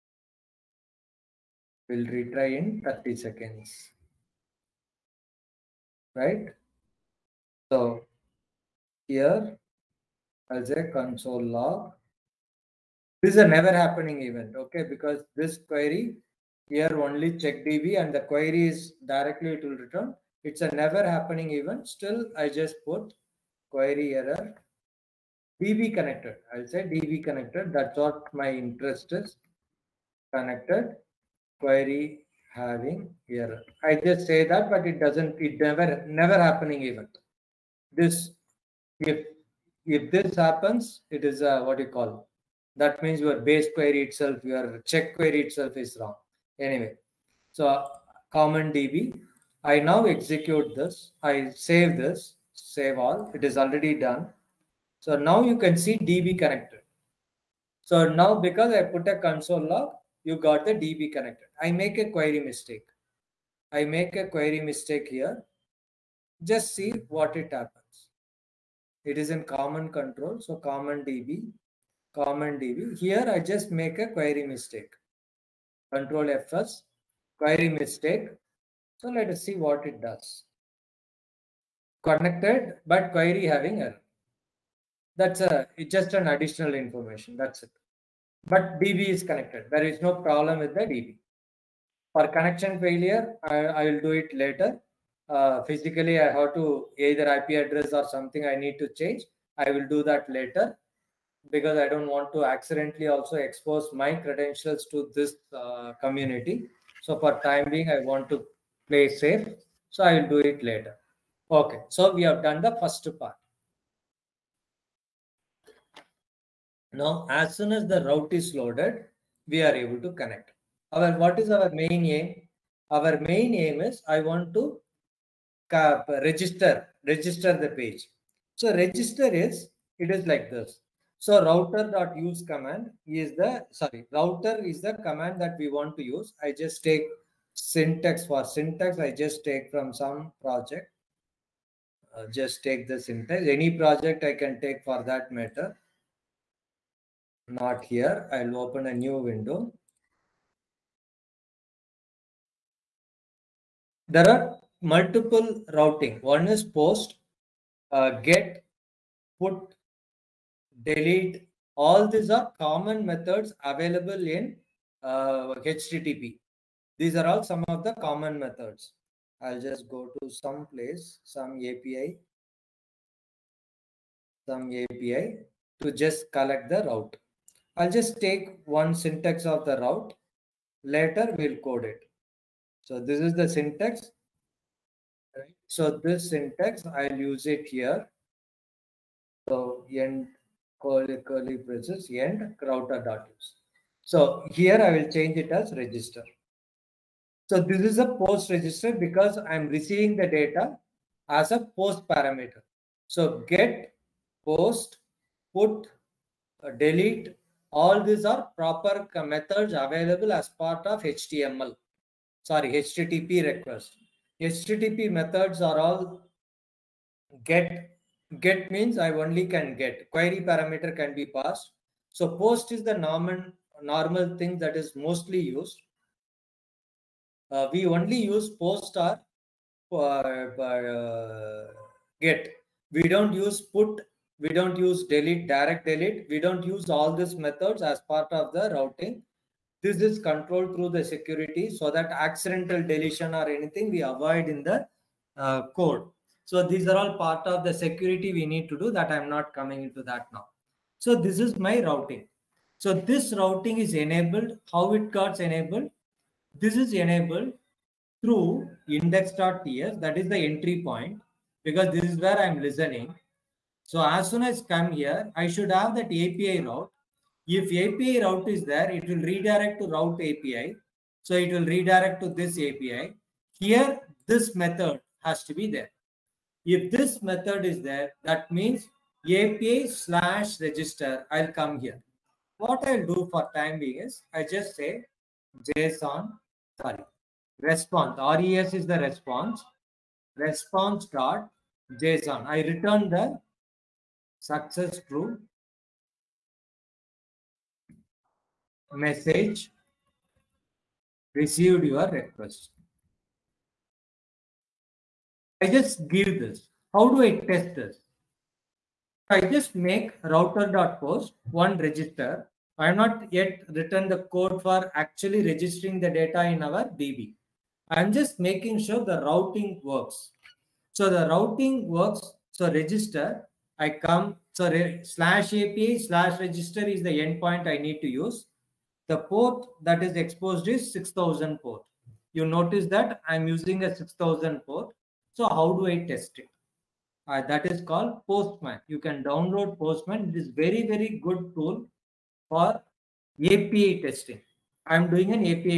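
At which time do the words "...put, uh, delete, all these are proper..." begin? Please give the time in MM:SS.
03:25.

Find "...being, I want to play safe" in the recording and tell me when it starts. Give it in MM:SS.
01:47.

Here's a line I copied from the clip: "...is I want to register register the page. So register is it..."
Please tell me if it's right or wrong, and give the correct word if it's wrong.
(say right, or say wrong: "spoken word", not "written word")
right.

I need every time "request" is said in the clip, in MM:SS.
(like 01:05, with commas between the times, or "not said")
03:33, 05:02.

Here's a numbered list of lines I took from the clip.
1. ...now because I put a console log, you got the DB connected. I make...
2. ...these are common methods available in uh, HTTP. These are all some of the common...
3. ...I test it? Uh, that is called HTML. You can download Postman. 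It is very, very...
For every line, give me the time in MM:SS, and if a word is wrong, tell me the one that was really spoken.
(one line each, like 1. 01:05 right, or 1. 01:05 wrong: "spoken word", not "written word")
1. 00:58 right
2. 02:42 right
3. 05:35 wrong: "Postman", not "HTML".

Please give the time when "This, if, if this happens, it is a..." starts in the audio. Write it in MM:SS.
00:37.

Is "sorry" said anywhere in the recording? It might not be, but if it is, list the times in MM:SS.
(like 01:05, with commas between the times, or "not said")
02:13, 03:32, 04:46.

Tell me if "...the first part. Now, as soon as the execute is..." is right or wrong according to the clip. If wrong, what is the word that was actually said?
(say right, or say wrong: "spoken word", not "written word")
wrong: "route", not "execute".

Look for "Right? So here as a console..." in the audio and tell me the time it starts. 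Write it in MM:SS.
00:06.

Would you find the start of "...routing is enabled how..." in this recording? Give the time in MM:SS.
04:13.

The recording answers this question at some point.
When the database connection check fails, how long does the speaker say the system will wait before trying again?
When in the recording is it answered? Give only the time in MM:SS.
00:02.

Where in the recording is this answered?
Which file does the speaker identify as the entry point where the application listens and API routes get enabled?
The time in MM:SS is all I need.
04:18.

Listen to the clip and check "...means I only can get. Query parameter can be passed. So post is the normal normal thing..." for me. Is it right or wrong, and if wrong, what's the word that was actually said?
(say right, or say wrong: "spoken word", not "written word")
right.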